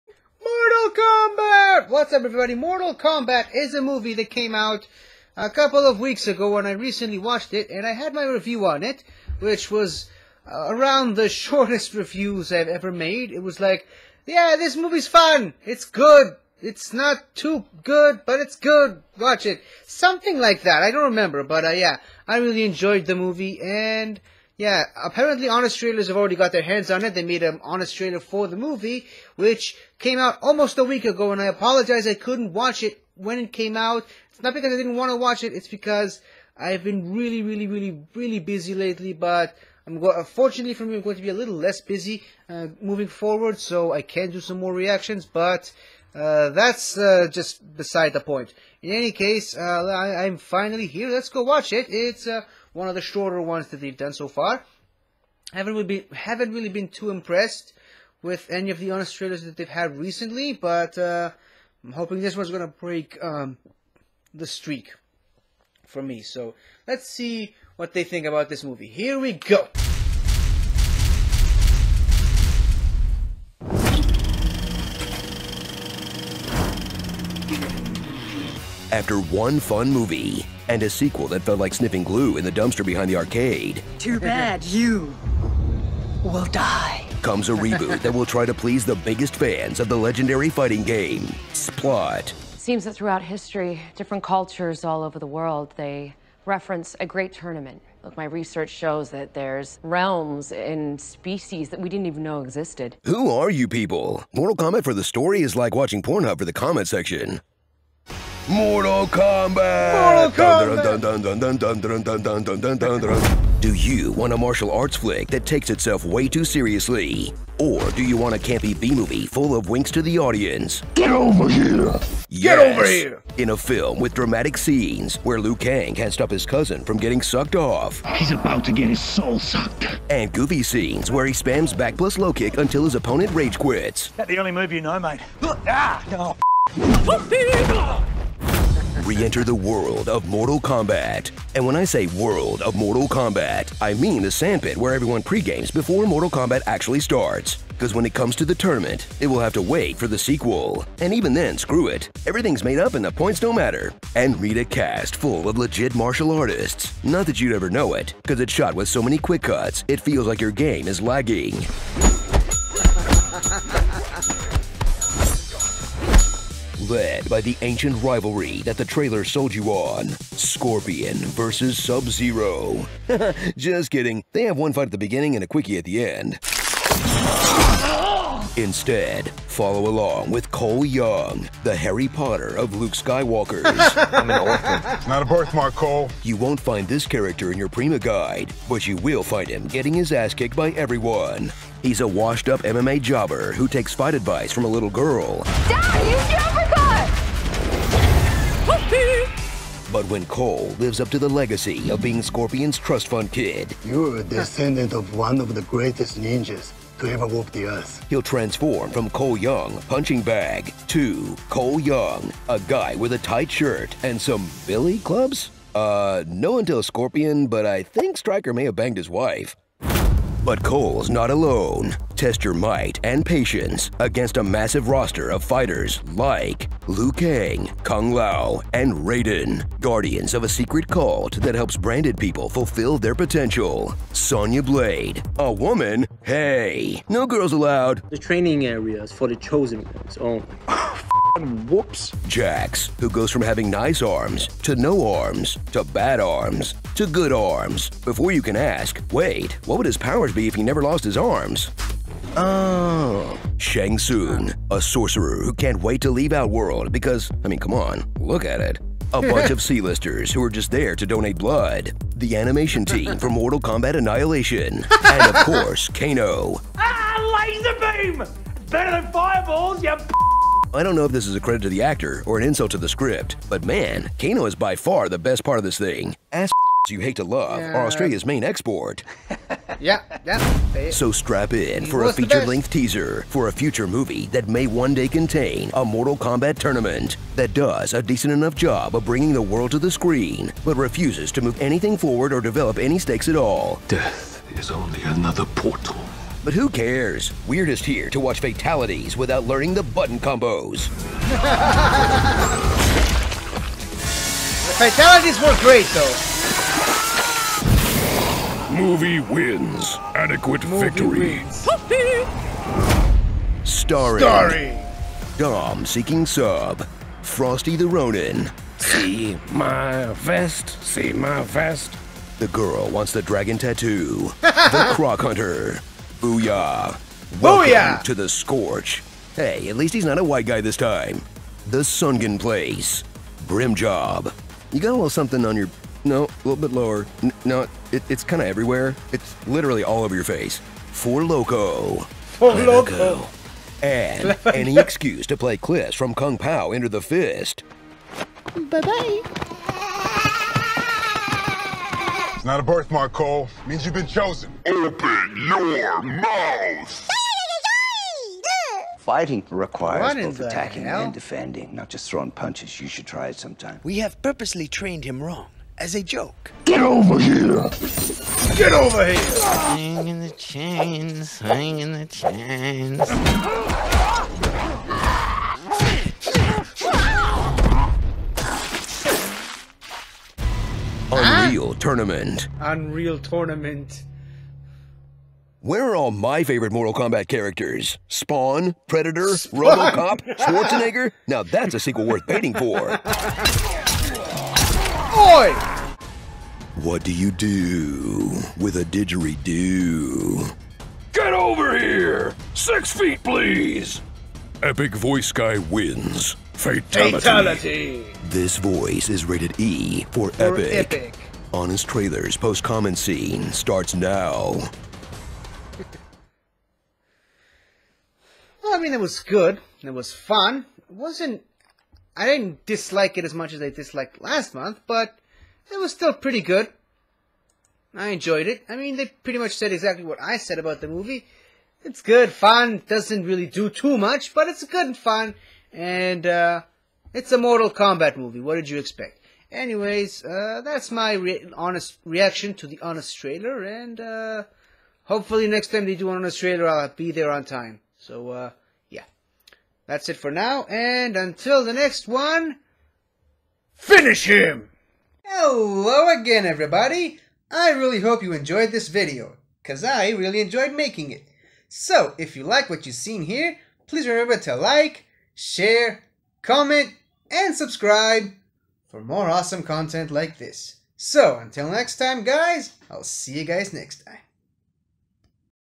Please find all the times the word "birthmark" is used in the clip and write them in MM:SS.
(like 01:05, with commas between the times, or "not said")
03:05, 05:52.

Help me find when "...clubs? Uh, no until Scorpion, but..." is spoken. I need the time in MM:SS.
03:34.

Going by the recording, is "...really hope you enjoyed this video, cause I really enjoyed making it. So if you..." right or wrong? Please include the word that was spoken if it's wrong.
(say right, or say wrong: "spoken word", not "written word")
right.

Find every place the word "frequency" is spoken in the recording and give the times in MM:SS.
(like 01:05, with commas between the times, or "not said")
not said.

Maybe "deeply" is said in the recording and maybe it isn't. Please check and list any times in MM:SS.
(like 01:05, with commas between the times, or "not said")
not said.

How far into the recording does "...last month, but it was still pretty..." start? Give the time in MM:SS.
07:04.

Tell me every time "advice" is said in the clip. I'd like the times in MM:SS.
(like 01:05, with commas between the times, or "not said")
03:14.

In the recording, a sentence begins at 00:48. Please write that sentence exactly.
In any case, uh, I- am finally here.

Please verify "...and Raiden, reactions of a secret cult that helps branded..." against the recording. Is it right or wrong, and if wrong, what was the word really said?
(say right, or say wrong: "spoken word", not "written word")
wrong: "guardians", not "reactions".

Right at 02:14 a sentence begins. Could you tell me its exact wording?
That's the only move you know, mate.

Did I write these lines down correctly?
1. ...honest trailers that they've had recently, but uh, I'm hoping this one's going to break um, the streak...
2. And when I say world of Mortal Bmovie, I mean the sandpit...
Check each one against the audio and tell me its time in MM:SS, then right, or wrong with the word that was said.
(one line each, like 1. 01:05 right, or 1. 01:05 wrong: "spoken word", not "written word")
1. 00:58 right
2. 02:21 wrong: "Kombat", not "Bmovie".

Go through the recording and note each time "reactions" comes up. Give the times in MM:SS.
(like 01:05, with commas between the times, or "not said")
00:44, 07:22.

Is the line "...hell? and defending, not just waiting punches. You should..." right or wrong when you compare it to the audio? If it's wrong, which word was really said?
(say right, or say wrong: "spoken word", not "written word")
wrong: "throwing", not "waiting".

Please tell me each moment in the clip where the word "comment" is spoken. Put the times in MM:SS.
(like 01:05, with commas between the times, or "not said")
01:46, 06:52, 07:46.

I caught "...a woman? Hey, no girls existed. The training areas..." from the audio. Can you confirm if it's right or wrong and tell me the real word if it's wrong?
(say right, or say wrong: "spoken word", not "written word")
wrong: "allowed", not "existed".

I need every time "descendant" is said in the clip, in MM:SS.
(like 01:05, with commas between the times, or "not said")
03:24.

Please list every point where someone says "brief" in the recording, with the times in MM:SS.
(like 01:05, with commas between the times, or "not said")
not said.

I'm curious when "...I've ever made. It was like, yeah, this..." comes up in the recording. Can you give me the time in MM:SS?
00:12.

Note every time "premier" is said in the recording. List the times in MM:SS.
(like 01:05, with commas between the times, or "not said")
not said.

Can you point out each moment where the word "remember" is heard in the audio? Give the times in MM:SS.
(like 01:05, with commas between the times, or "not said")
00:21, 07:44.